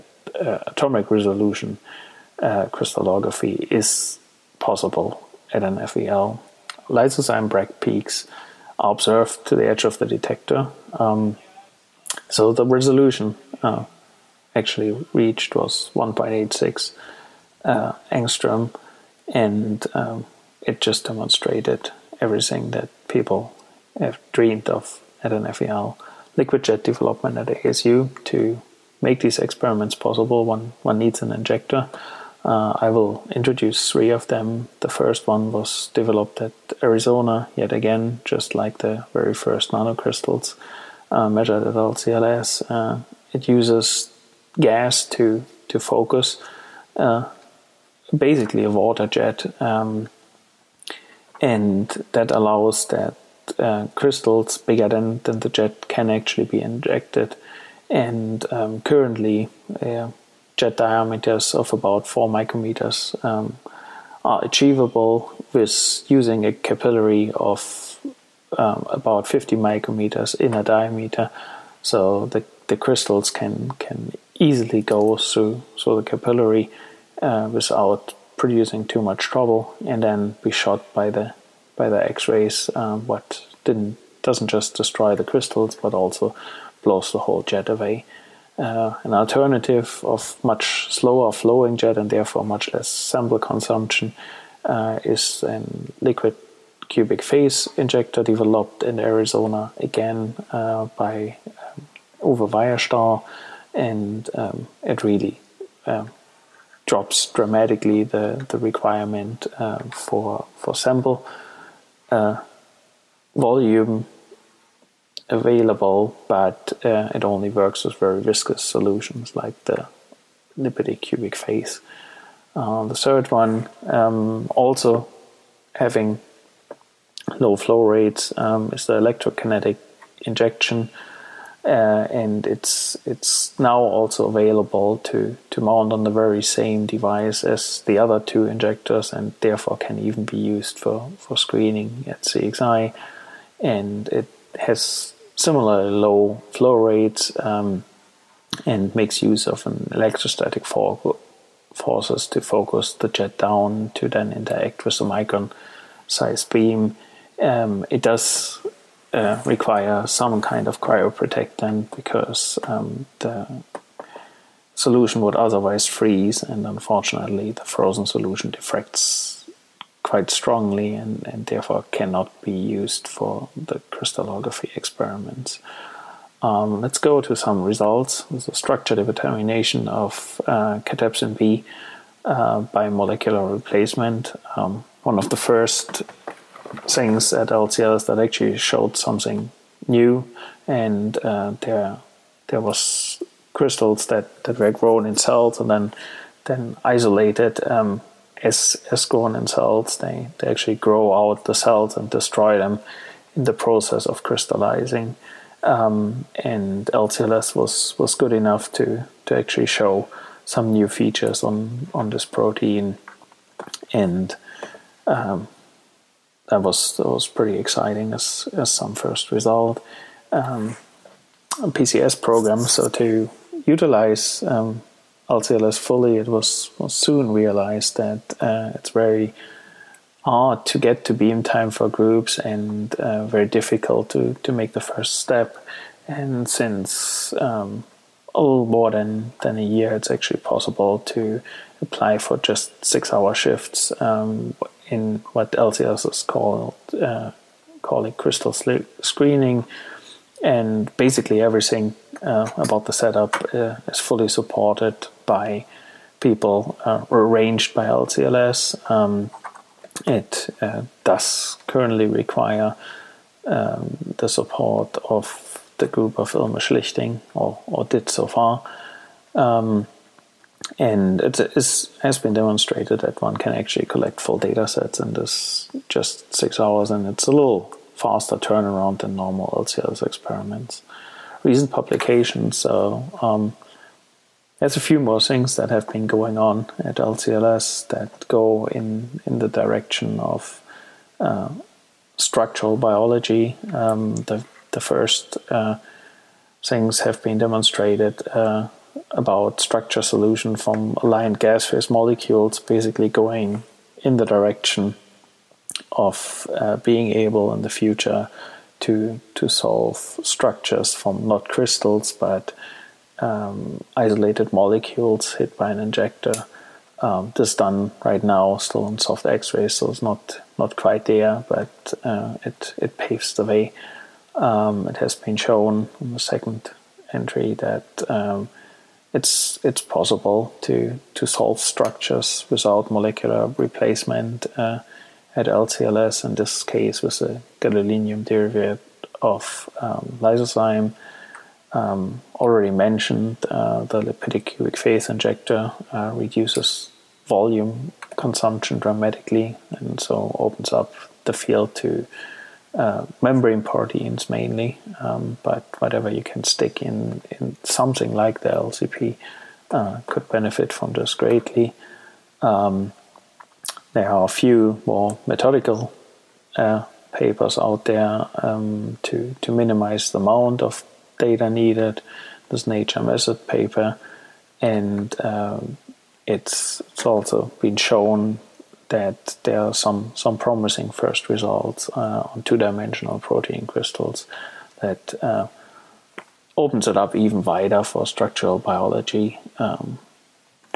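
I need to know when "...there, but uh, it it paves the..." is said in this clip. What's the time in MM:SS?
05:21.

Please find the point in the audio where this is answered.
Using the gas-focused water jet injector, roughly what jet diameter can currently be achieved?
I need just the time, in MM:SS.
01:02.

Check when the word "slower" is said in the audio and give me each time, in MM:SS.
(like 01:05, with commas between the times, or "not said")
01:30.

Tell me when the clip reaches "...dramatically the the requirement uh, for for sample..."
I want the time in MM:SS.
01:47.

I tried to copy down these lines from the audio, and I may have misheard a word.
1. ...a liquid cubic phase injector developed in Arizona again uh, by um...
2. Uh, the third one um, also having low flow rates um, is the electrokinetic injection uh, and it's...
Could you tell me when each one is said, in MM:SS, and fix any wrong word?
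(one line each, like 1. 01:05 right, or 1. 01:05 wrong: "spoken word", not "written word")
1. 01:35 right
2. 02:02 right.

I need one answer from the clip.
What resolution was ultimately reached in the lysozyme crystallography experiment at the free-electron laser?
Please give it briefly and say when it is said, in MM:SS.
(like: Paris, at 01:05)
1.86 angstrom, at 00:15.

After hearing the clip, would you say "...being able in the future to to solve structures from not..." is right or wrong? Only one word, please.
right.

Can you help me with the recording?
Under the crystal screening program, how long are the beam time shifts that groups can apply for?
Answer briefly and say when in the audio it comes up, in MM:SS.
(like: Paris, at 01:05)
6 hours, at 04:02.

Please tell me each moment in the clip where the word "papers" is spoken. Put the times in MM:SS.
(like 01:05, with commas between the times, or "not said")
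06:07, 06:13.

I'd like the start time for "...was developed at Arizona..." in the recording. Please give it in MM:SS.
00:35.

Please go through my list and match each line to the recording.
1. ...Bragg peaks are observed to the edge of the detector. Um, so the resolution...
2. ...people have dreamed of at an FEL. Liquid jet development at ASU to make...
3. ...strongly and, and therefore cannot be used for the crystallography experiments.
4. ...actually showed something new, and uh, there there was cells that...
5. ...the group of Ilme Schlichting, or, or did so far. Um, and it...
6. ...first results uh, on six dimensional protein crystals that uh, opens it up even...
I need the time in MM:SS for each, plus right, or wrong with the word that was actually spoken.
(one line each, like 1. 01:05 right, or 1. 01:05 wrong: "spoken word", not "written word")
1. 00:07 right
2. 00:23 right
3. 02:50 right
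4. 03:08 wrong: "crystals", not "cells"
5. 04:25 right
6. 06:20 wrong: "two", not "six".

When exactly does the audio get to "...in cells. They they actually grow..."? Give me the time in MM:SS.
03:19.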